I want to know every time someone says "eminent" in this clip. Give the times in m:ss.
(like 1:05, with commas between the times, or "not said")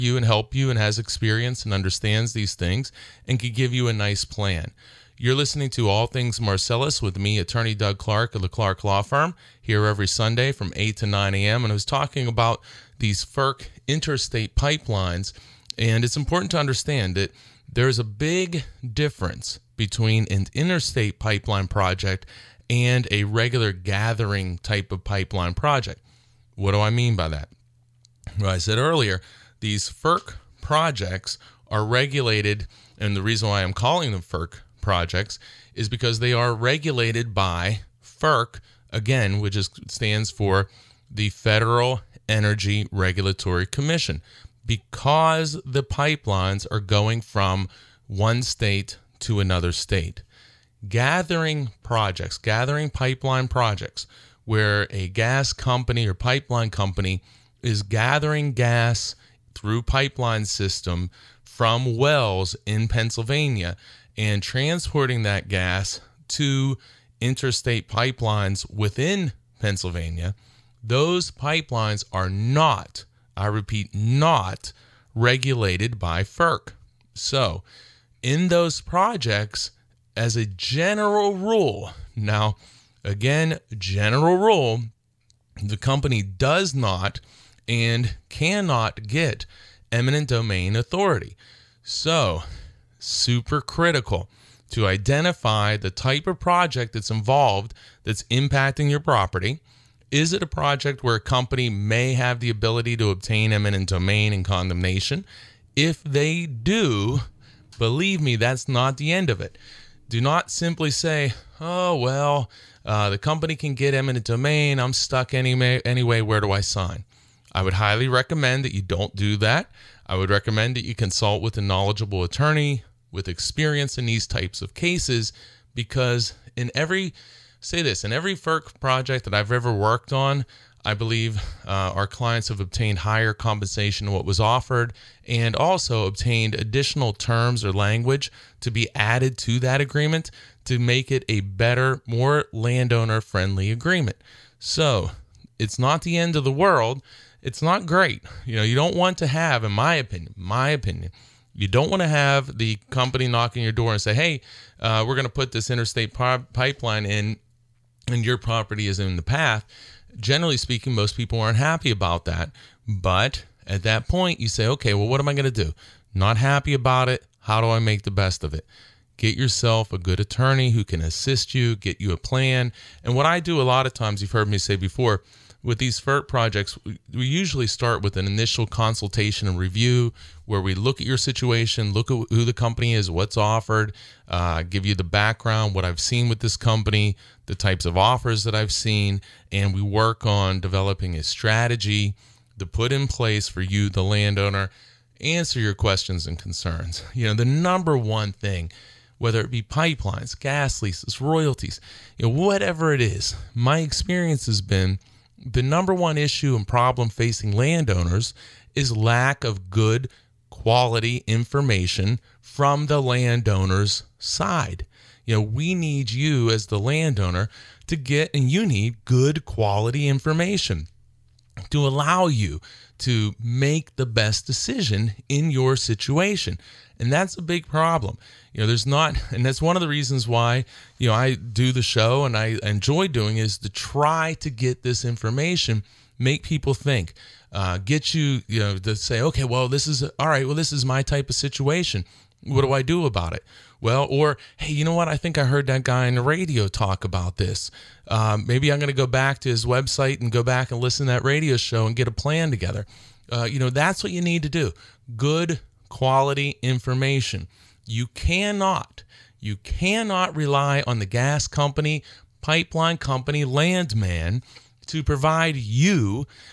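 1:29, 1:43, 1:53.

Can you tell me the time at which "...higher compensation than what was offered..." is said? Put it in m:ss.
2:12.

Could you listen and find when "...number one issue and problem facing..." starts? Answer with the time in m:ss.
3:25.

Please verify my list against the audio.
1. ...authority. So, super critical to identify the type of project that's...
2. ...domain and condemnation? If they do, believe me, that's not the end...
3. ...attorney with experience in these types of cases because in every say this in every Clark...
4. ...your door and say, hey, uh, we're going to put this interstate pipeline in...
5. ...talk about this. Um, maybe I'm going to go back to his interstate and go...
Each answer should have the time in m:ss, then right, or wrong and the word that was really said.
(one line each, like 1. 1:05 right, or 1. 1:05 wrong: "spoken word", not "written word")
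1. 1:30 right
2. 1:43 right
3. 2:02 wrong: "FERC", not "Clark"
4. 2:33 right
5. 4:06 wrong: "website", not "interstate".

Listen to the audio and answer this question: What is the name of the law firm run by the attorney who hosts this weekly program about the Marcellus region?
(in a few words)
Clark Law Firm.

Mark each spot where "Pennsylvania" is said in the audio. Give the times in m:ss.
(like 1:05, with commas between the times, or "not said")
1:02, 1:09.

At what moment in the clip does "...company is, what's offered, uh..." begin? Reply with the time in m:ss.
3:02.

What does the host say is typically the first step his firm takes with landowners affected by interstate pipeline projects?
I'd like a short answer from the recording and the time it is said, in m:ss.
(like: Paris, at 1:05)
Initial consultation and review, at 2:58.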